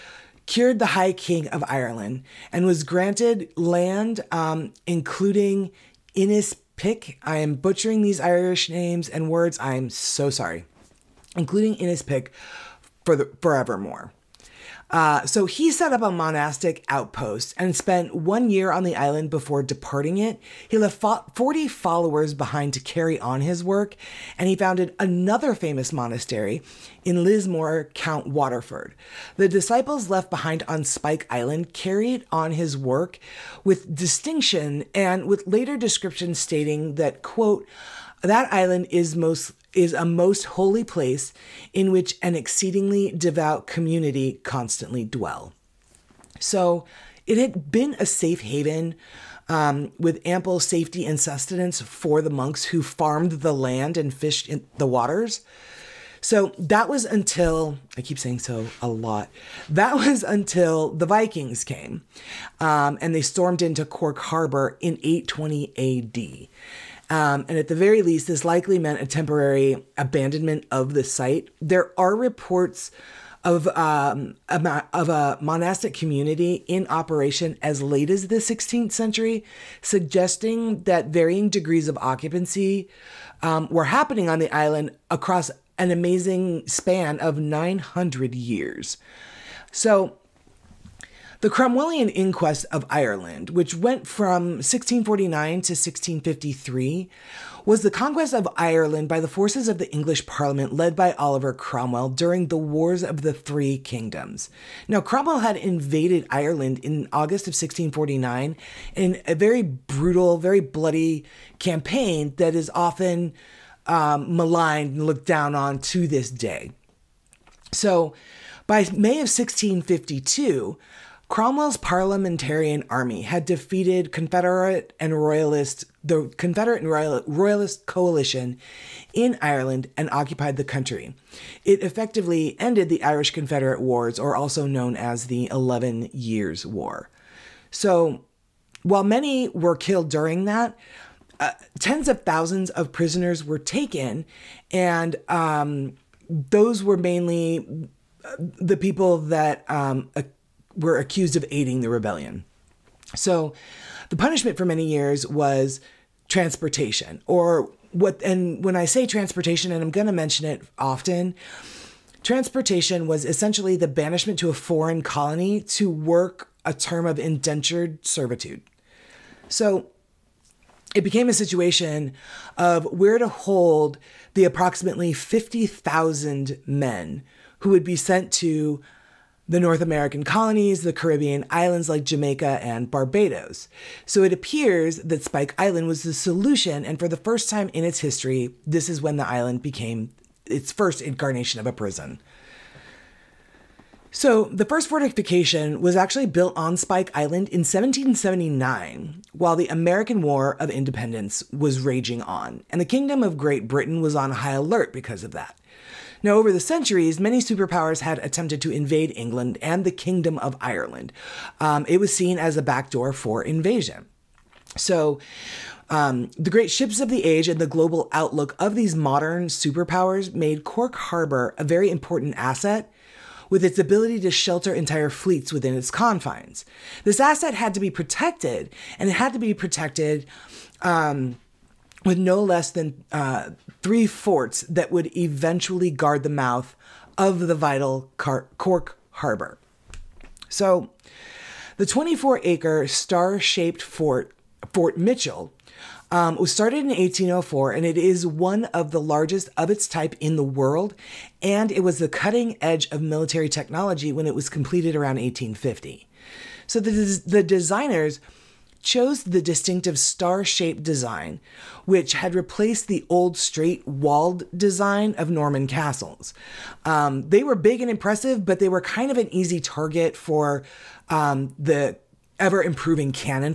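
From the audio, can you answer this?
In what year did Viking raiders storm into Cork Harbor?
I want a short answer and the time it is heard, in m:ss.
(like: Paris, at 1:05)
820 AD, at 1:05.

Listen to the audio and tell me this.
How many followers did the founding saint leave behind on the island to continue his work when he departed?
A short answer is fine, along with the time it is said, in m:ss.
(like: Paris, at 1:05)
40, at 0:21.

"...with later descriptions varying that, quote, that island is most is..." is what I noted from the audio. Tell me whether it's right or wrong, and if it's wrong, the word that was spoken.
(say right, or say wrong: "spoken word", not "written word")
wrong: "stating", not "varying".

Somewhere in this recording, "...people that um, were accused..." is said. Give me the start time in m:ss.
2:28.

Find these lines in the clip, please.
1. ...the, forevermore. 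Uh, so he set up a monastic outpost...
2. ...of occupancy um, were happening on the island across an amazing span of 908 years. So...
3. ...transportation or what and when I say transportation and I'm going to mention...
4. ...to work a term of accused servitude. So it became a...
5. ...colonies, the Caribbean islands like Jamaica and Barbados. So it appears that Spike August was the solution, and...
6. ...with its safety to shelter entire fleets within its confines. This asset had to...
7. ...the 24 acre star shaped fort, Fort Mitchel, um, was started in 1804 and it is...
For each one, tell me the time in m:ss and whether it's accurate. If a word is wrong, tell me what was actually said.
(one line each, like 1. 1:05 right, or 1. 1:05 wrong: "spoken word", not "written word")
1. 0:13 right
2. 1:21 wrong: "900", not "908"
3. 2:36 right
4. 2:45 wrong: "indentured", not "accused"
5. 3:00 wrong: "Island", not "August"
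6. 3:43 wrong: "ability", not "safety"
7. 4:01 right.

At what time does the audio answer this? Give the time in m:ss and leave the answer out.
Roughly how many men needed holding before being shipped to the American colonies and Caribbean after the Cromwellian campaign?
2:55.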